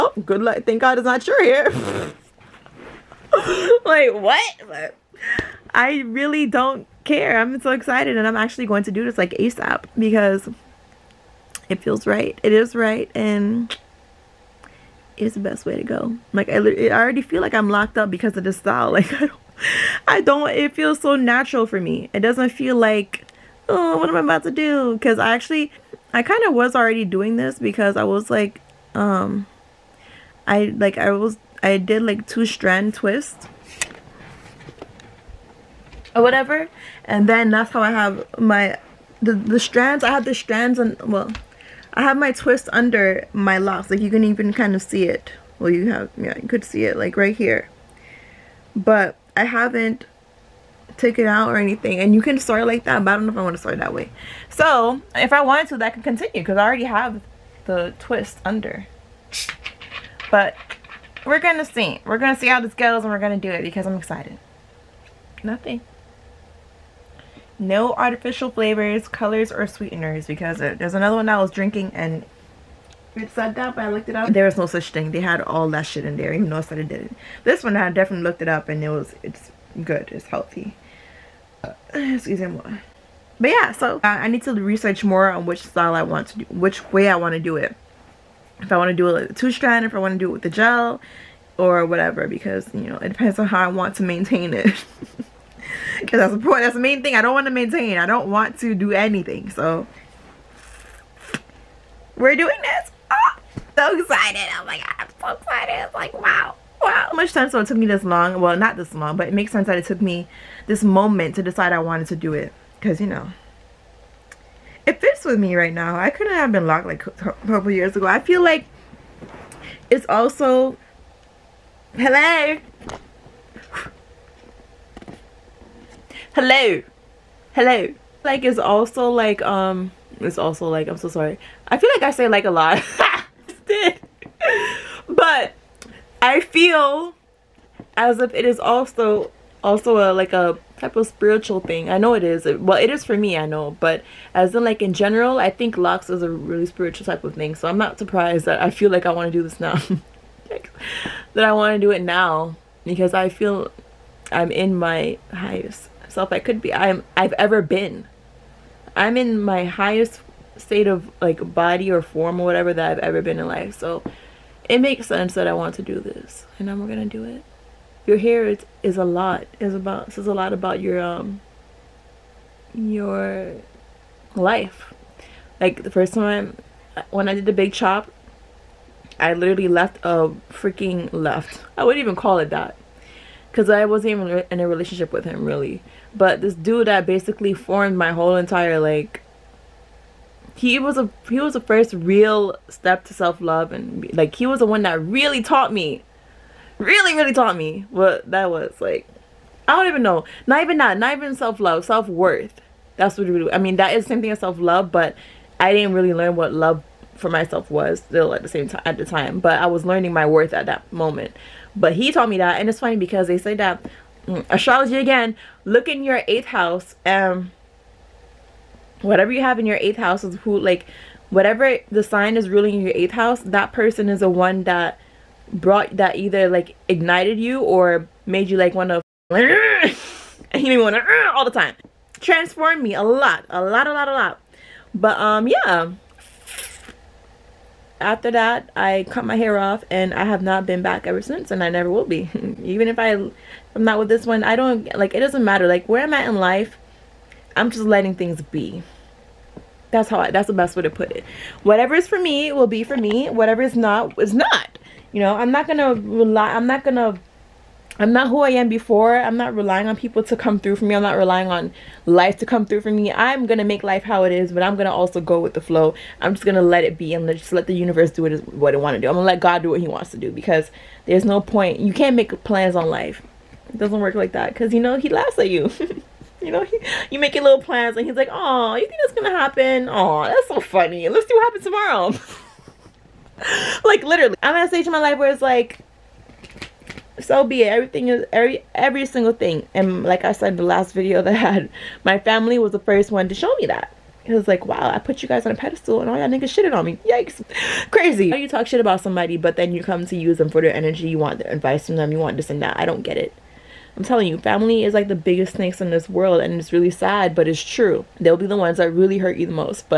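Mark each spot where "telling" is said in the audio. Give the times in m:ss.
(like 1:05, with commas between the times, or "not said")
5:04.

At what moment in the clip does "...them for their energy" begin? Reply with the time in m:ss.
5:00.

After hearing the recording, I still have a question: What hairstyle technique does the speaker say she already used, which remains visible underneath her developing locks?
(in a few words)
two strand twists.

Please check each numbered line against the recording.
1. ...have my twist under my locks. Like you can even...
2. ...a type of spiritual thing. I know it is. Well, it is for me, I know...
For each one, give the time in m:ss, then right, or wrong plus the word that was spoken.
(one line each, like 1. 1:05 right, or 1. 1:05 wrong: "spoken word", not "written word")
1. 0:42 right
2. 2:20 right.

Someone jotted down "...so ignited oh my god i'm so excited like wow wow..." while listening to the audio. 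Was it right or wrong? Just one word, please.
wrong.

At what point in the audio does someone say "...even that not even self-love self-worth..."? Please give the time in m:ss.
3:20.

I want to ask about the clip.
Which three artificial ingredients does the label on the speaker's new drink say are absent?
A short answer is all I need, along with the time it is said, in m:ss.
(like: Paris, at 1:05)
flavors colors or sweeteners, at 1:08.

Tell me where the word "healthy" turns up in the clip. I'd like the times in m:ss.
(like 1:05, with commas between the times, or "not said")
1:20.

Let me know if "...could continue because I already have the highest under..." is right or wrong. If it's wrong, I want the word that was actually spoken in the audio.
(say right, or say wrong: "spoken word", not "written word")
wrong: "twist", not "highest".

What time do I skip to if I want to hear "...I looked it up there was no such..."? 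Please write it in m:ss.
1:13.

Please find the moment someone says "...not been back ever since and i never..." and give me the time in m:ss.
4:00.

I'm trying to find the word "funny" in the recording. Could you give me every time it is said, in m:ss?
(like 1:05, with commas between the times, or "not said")
3:32, 4:40.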